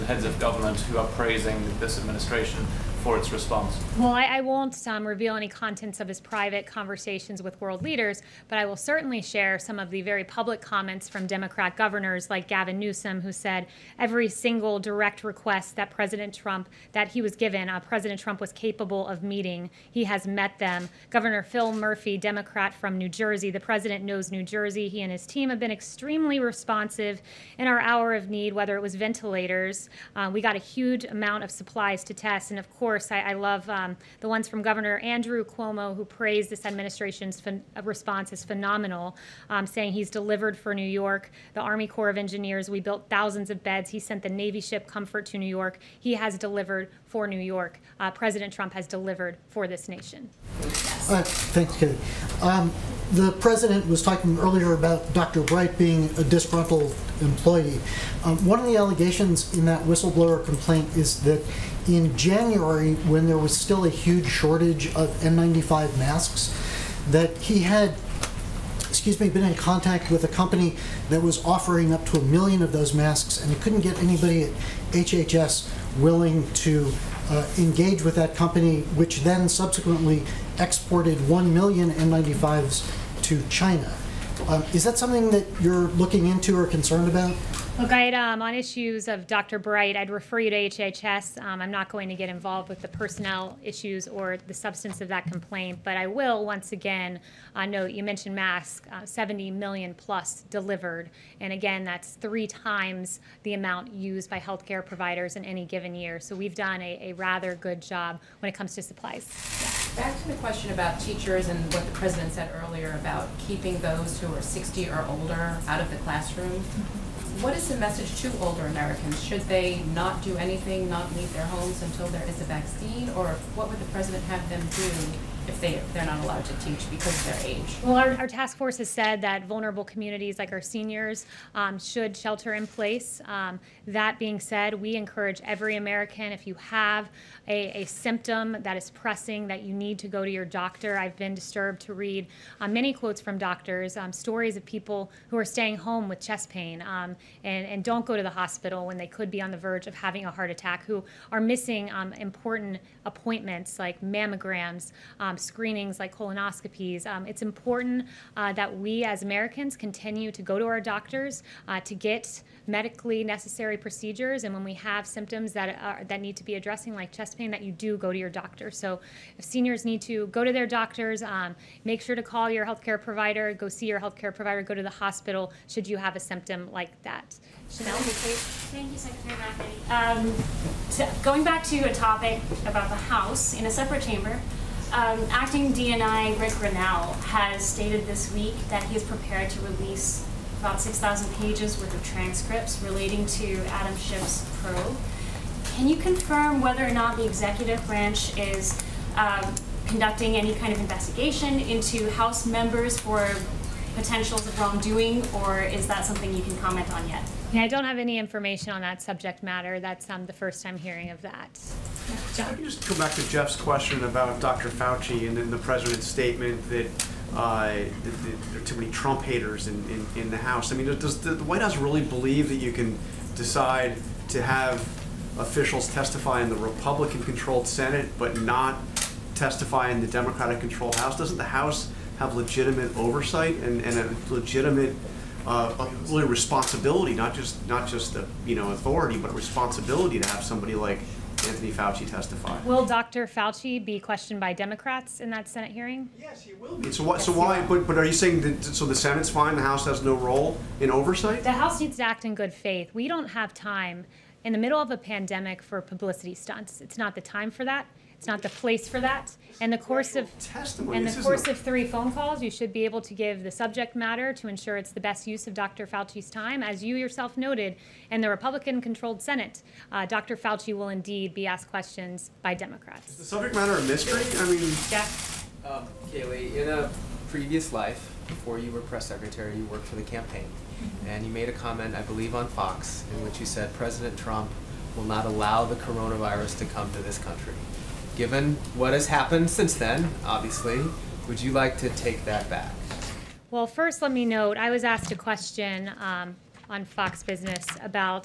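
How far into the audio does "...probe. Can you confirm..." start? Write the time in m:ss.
3:14.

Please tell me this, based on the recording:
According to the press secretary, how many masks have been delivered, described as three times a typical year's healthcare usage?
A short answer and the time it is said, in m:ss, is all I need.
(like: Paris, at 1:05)
70 million plus, at 1:39.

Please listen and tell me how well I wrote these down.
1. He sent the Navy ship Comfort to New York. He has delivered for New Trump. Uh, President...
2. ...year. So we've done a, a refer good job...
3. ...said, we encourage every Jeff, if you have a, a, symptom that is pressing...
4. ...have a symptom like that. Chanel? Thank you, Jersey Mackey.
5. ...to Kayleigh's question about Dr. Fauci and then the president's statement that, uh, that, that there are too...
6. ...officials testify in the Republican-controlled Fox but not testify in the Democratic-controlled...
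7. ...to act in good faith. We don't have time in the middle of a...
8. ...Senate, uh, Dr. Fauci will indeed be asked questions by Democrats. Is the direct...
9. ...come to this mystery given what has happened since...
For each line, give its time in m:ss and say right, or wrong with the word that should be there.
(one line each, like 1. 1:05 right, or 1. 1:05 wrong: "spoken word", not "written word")
1. 0:43 wrong: "York", not "Trump"
2. 1:45 wrong: "rather", not "refer"
3. 2:14 wrong: "American", not "Jeff"
4. 2:55 wrong: "Secretary", not "Jersey"
5. 3:33 wrong: "Jeff", not "Kayleigh"
6. 3:45 wrong: "Senate", not "Fox"
7. 4:11 right
8. 4:29 wrong: "subject", not "direct"
9. 4:46 wrong: "country", not "mystery".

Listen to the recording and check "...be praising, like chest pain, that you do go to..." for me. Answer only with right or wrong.
wrong.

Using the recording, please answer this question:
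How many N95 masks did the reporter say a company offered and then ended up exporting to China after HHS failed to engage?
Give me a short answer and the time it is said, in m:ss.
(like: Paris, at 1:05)
1 million, at 1:21.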